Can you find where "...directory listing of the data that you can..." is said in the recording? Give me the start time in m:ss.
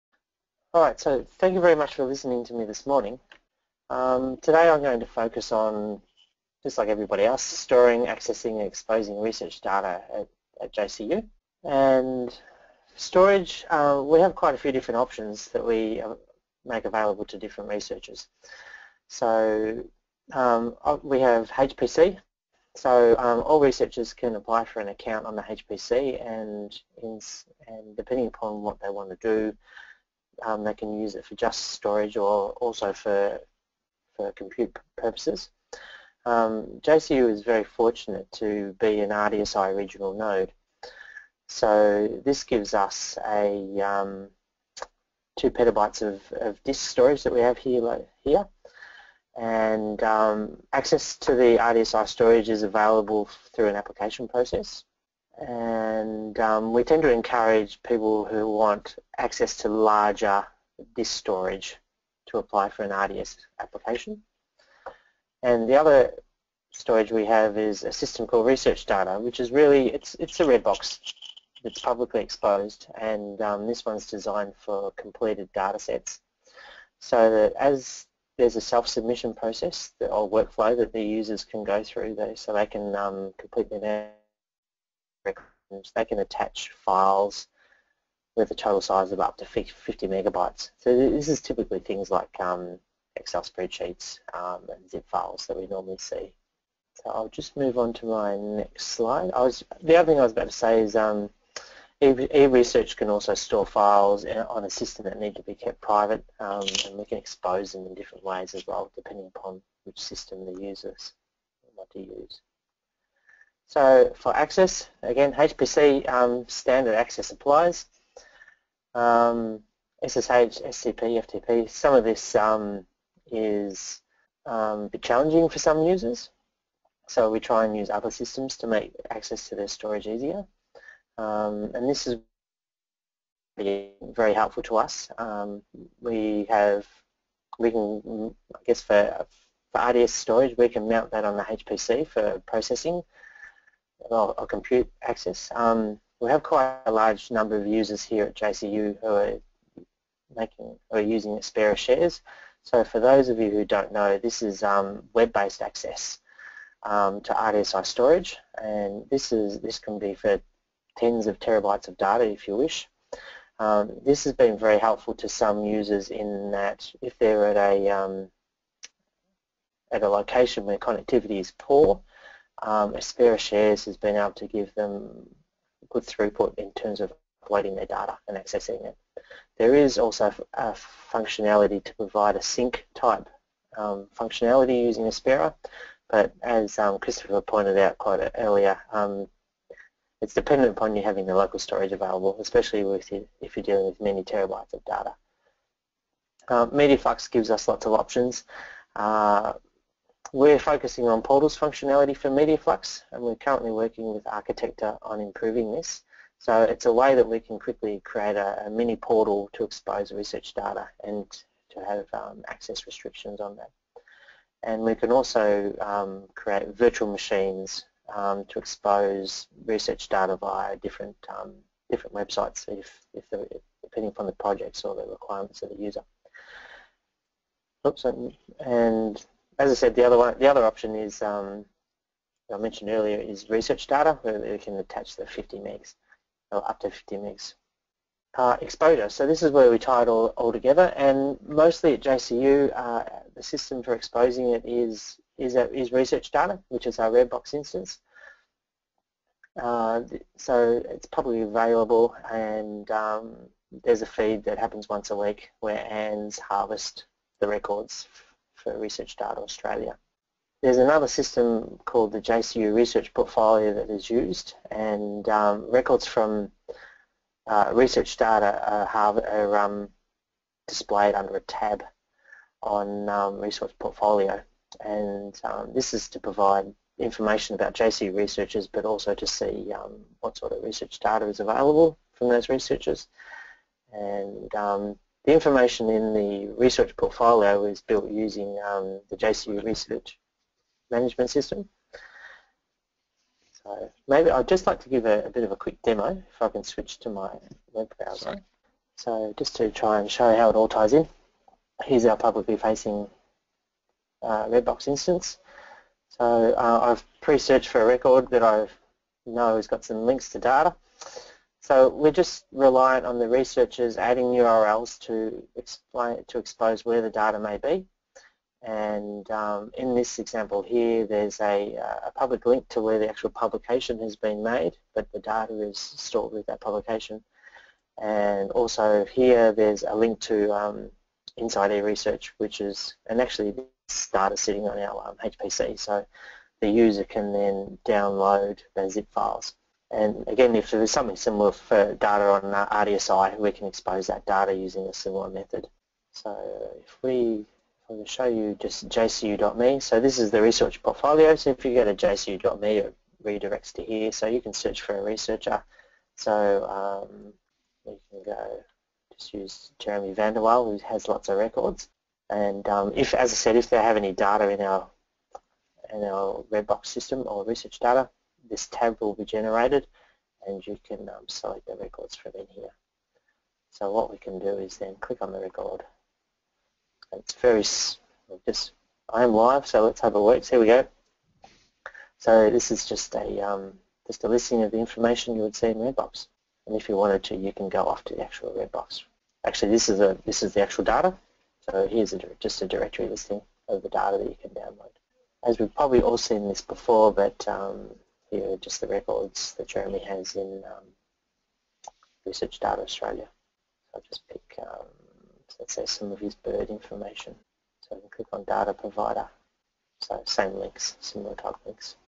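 6:32.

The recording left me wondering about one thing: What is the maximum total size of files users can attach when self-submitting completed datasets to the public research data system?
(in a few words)
50 megabytes.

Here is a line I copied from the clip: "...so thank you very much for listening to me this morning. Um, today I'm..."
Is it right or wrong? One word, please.
right.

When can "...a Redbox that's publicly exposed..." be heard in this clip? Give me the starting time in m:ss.
1:10.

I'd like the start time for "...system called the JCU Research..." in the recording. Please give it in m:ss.
4:21.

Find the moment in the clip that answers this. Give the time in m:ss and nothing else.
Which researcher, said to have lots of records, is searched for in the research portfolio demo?
5:59.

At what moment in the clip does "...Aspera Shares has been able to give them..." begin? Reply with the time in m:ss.
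2:52.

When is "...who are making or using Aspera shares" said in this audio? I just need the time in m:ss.
2:28.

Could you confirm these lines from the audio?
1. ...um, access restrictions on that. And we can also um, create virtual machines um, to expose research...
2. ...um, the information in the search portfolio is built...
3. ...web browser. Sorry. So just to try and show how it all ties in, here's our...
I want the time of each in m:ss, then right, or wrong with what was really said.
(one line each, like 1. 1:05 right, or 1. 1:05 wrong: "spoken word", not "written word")
1. 3:32 right
2. 4:44 wrong: "research", not "search"
3. 4:57 right.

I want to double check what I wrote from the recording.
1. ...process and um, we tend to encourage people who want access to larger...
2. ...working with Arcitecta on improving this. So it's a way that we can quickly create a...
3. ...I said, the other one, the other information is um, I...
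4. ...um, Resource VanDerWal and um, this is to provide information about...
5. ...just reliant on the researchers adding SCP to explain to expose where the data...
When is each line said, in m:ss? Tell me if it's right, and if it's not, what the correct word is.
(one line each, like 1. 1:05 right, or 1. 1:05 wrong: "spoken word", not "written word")
1. 0:54 right
2. 3:23 right
3. 3:49 wrong: "option", not "information"
4. 4:33 wrong: "Portfolio", not "VanDerWal"
5. 5:12 wrong: "URLs", not "SCP".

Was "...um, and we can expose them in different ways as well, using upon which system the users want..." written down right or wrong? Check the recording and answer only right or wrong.
wrong.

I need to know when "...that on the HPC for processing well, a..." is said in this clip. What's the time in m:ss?
2:21.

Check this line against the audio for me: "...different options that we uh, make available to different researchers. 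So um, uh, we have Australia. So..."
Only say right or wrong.
wrong.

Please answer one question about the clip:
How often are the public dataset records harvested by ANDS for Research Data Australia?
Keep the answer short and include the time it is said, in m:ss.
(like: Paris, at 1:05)
once a week, at 4:14.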